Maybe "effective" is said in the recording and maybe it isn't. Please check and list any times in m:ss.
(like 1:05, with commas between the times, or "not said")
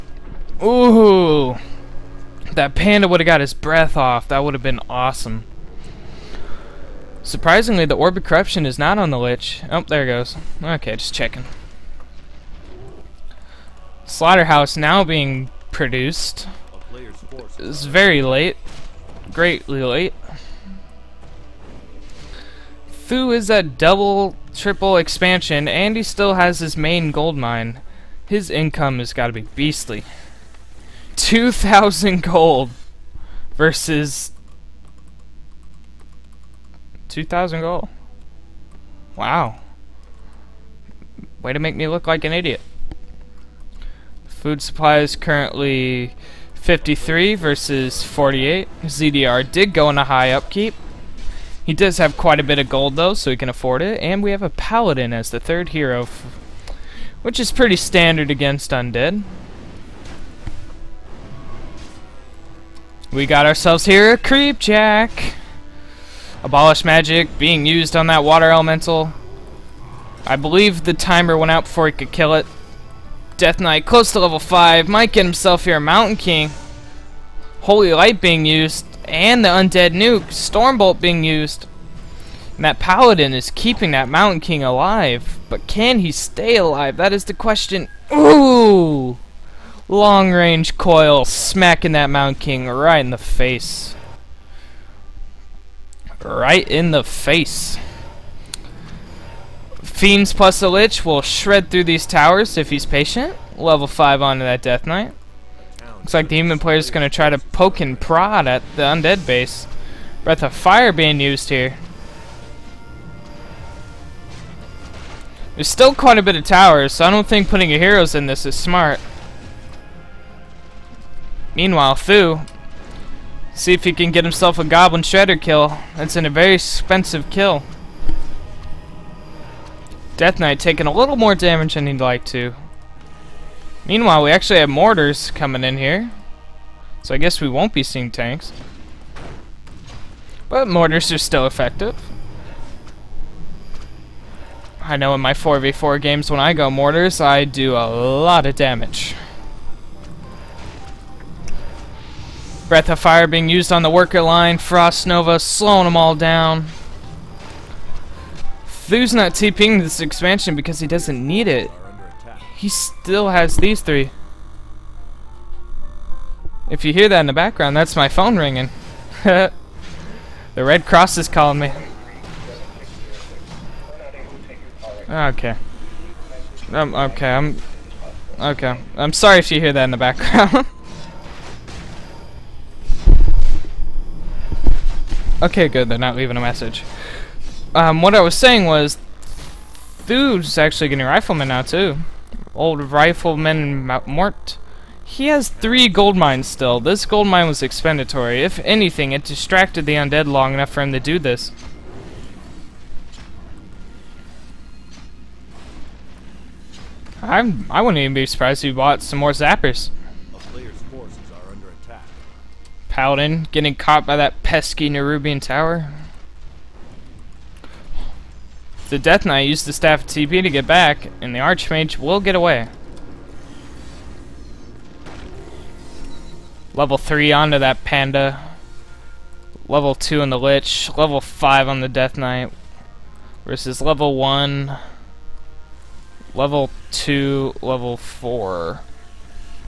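2:21.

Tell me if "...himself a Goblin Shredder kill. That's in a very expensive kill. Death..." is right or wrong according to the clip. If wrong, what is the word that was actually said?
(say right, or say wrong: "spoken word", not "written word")
right.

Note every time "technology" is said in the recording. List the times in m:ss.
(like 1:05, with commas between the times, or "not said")
not said.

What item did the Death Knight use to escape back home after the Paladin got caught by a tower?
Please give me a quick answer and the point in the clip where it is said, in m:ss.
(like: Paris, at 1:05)
Staff of TP, at 3:39.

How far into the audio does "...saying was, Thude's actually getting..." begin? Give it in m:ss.
3:08.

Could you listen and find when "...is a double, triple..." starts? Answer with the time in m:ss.
0:23.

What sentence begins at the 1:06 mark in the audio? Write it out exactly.
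Abolish magic being used on that water elemental.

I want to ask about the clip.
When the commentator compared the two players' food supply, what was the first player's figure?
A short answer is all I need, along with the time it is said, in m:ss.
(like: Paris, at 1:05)
53, at 0:46.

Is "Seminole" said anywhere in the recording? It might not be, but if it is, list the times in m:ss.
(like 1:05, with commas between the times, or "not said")
not said.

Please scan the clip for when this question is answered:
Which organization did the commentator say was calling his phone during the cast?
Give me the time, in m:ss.
2:50.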